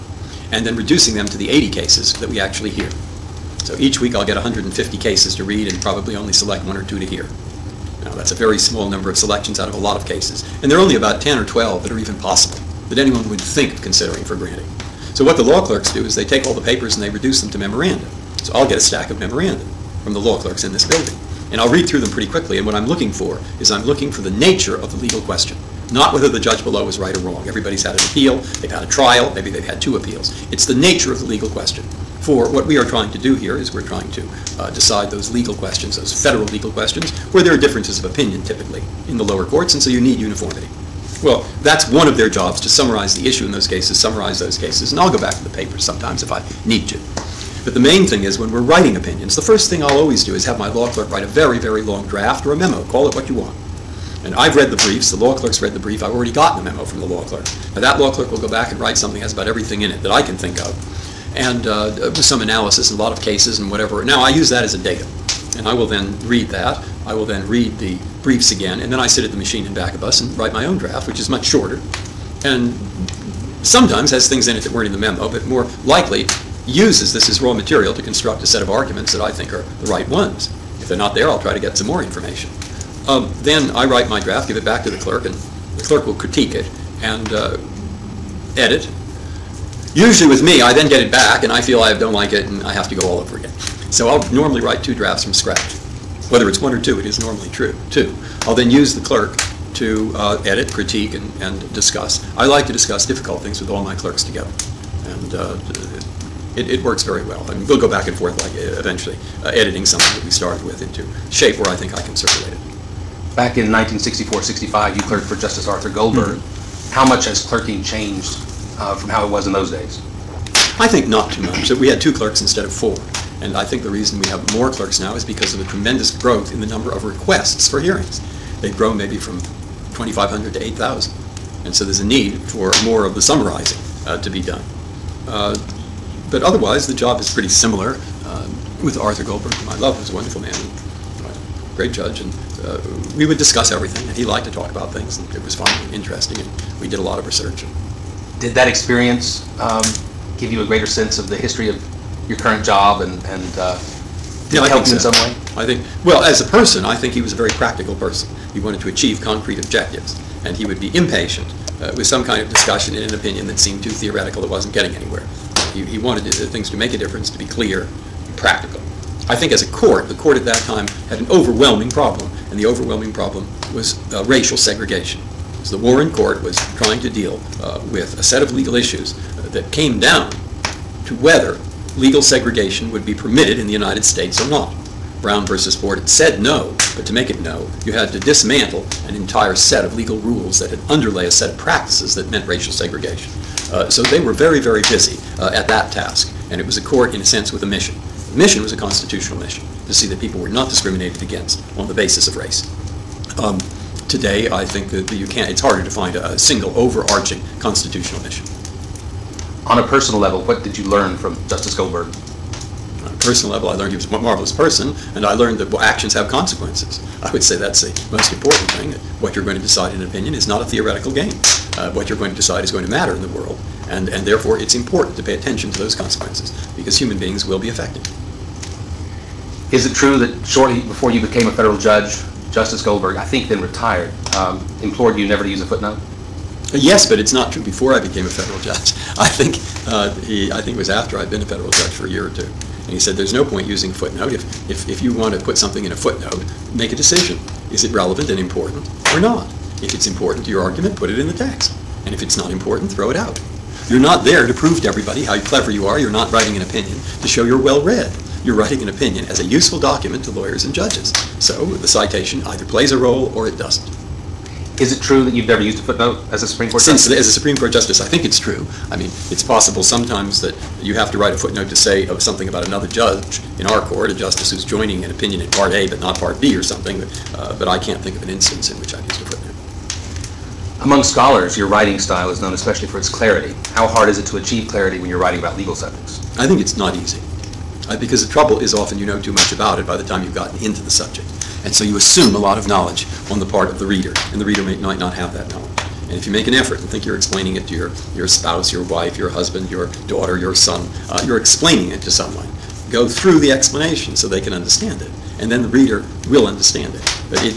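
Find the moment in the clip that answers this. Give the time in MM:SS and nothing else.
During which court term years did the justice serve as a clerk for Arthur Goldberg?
01:53.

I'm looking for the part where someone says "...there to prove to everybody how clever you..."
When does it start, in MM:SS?
04:14.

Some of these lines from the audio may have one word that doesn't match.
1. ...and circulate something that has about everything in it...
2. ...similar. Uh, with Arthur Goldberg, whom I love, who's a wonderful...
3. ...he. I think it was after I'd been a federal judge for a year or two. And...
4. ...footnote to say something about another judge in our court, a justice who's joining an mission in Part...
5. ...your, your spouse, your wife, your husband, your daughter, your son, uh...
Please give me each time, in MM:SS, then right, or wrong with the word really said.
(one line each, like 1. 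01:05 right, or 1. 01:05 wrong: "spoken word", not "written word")
1. 00:58 wrong: "write", not "circulate"
2. 02:17 right
3. 04:00 right
4. 04:31 wrong: "opinion", not "mission"
5. 04:57 right.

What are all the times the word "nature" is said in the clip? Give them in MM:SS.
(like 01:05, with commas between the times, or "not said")
00:24, 00:30.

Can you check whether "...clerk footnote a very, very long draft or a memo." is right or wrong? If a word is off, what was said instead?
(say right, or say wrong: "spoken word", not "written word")
wrong: "write", not "footnote".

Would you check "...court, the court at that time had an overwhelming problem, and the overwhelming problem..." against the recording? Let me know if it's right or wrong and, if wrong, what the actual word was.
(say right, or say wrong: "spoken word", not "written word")
right.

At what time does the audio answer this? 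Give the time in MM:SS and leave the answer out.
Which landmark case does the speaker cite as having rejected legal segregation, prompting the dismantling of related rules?
03:05.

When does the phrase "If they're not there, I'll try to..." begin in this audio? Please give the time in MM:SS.
01:20.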